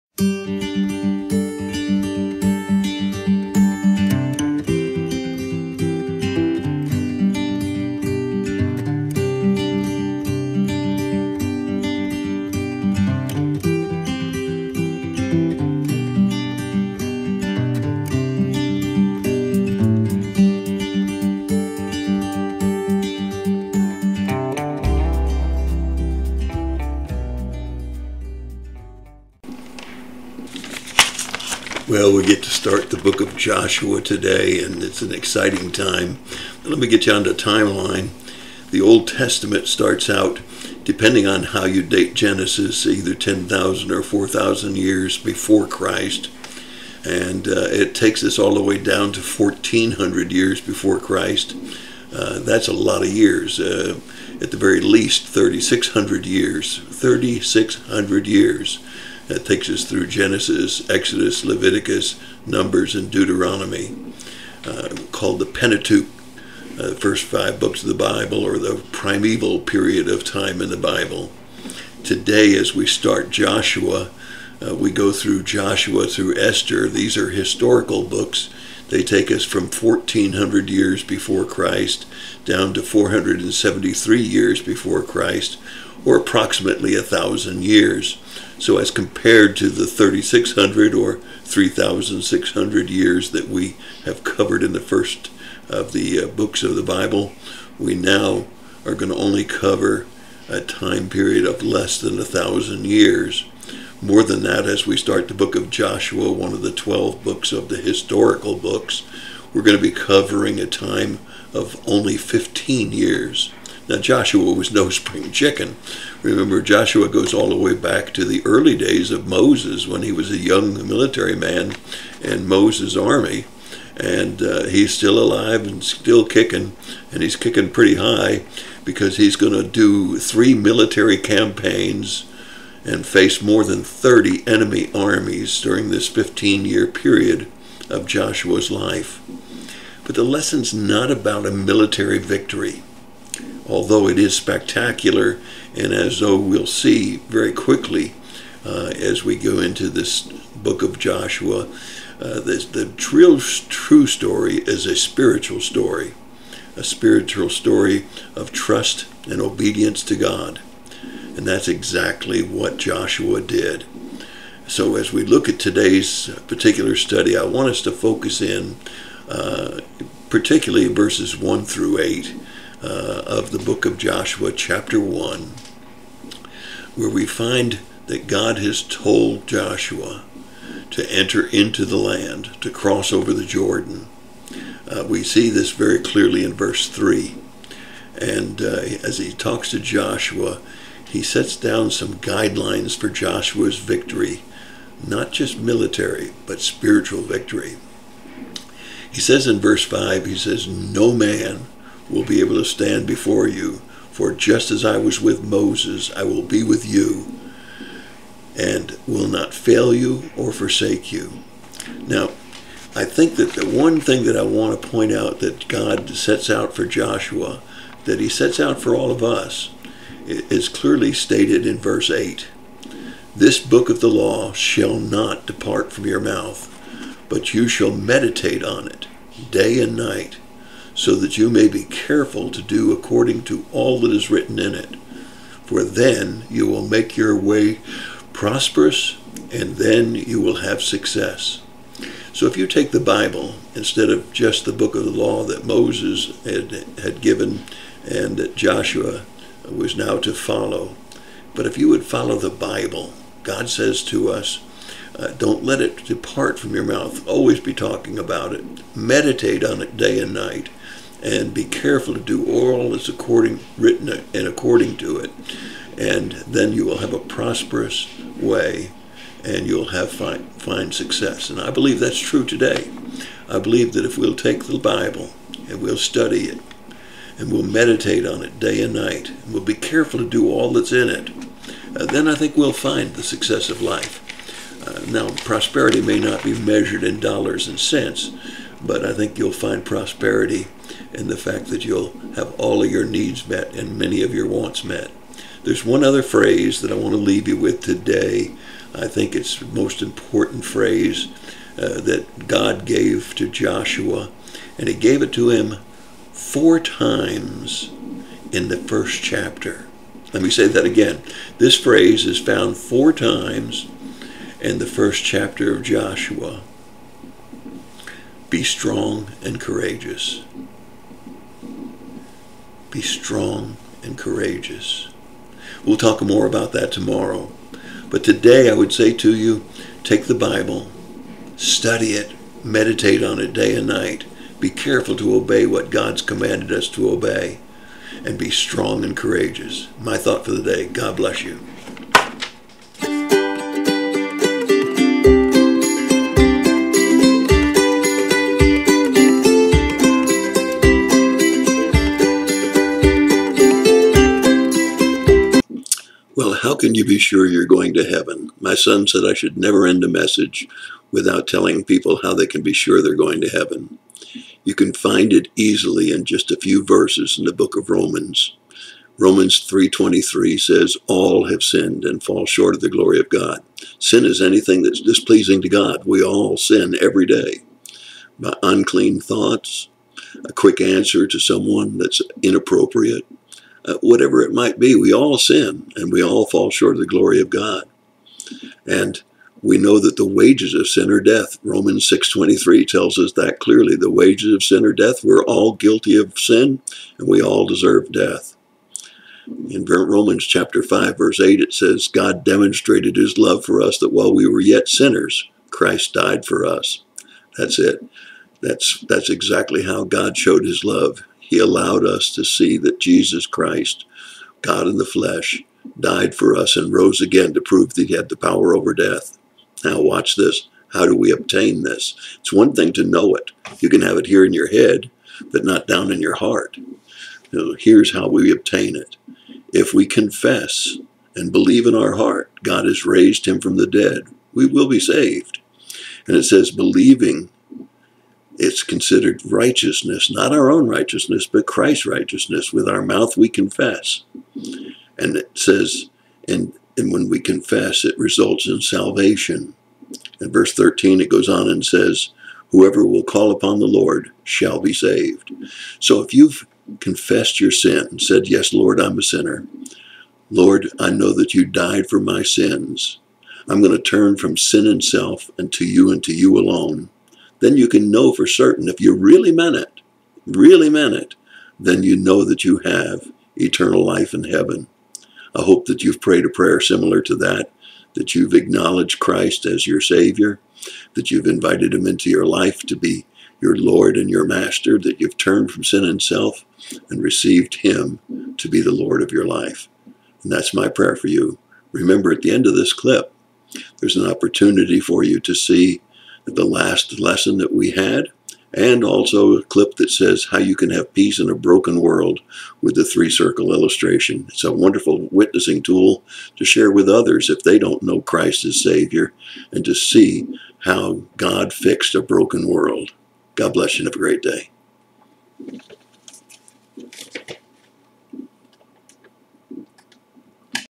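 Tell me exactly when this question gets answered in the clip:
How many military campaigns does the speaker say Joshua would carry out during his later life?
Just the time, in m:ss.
2:10.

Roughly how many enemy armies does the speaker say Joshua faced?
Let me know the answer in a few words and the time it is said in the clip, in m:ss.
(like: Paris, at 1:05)
more than 30, at 2:13.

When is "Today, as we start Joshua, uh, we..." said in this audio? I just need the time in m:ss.
1:12.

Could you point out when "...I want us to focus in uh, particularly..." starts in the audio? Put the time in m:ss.
2:47.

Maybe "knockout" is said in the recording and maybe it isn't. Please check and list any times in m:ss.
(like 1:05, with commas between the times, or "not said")
not said.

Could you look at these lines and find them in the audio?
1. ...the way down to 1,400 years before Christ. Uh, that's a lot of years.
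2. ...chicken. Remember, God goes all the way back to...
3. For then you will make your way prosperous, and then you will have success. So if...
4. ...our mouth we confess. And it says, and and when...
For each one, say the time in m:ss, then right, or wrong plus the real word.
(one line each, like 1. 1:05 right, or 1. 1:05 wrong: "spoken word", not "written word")
1. 0:48 right
2. 1:55 wrong: "Joshua", not "God"
3. 3:55 right
4. 7:22 right.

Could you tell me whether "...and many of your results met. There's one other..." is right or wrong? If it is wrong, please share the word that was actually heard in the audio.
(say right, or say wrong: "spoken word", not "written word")
wrong: "wants", not "results".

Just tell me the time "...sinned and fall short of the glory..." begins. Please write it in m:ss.
6:11.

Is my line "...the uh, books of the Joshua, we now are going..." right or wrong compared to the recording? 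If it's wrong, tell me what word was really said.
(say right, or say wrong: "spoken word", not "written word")
wrong: "Bible", not "Joshua".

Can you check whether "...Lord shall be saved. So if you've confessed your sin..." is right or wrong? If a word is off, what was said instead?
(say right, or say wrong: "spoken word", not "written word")
right.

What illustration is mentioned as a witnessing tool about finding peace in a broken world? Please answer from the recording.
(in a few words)
three circle illustration.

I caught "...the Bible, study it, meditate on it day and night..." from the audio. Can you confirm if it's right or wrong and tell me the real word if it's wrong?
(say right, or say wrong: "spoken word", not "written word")
right.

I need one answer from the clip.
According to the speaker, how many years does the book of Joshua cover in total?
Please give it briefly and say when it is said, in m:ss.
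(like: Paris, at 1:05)
15 years, at 1:51.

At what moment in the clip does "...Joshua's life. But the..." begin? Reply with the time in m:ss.
2:18.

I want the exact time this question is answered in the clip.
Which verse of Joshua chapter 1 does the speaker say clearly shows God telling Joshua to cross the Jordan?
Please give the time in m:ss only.
3:06.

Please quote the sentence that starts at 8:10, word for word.
And that's my prayer for you.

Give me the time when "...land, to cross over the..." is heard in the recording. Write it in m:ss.
3:01.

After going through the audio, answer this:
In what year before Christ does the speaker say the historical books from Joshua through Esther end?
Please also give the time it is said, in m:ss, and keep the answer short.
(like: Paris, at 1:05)
473 BC, at 1:22.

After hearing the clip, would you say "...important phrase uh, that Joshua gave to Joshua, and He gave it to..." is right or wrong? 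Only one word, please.
wrong.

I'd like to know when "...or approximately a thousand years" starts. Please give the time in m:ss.
1:26.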